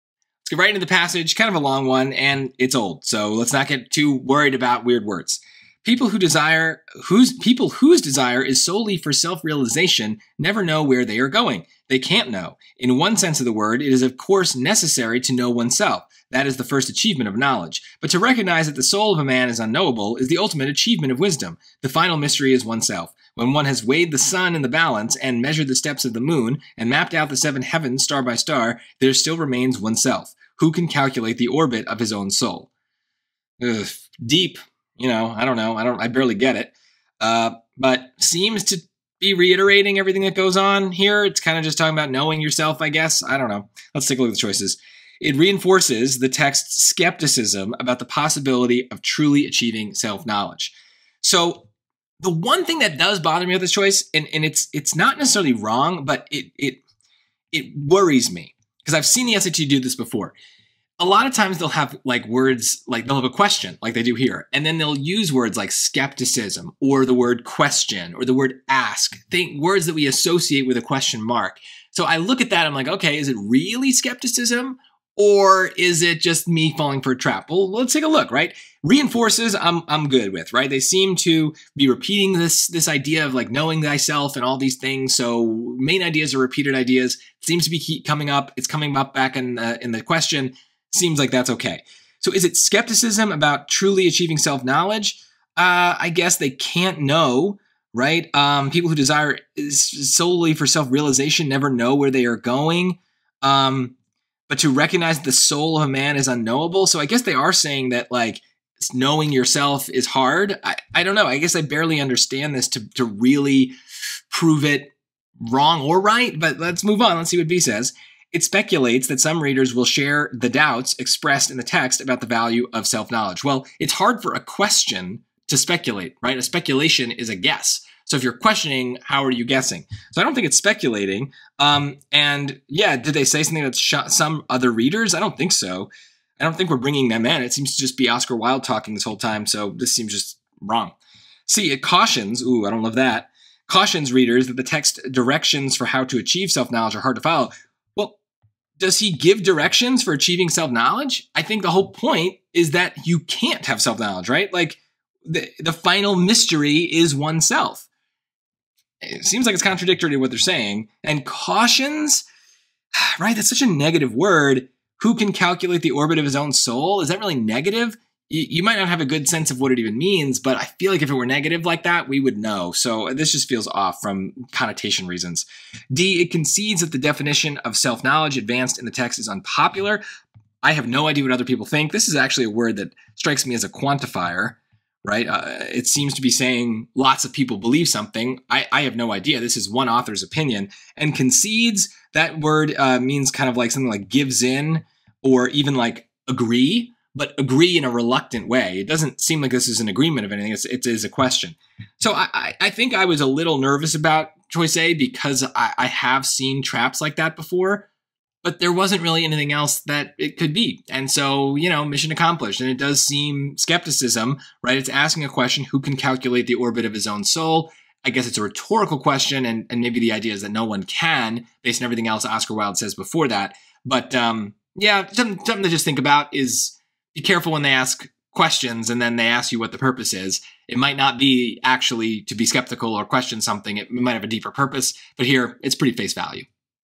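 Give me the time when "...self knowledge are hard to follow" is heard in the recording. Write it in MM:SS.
02:26.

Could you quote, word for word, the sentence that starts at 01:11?
So I look at that, I'm like, okay, is it really skepticism or is it just me falling for a trap?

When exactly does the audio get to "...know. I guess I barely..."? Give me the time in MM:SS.
01:51.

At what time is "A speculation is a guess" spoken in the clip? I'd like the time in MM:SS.
02:06.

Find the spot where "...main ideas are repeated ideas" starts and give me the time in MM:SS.
01:25.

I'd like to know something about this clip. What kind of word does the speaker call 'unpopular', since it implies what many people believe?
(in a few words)
A quantifier.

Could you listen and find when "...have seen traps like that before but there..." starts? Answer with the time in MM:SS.
03:25.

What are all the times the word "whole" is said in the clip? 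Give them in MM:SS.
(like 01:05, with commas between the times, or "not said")
02:19, 02:31.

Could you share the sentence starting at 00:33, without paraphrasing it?
Ugh, deep, you know, I don't know, I don't, I barely get it.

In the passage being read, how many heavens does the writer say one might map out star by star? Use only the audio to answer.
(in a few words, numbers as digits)
7.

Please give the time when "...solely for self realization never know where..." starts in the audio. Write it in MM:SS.
01:39.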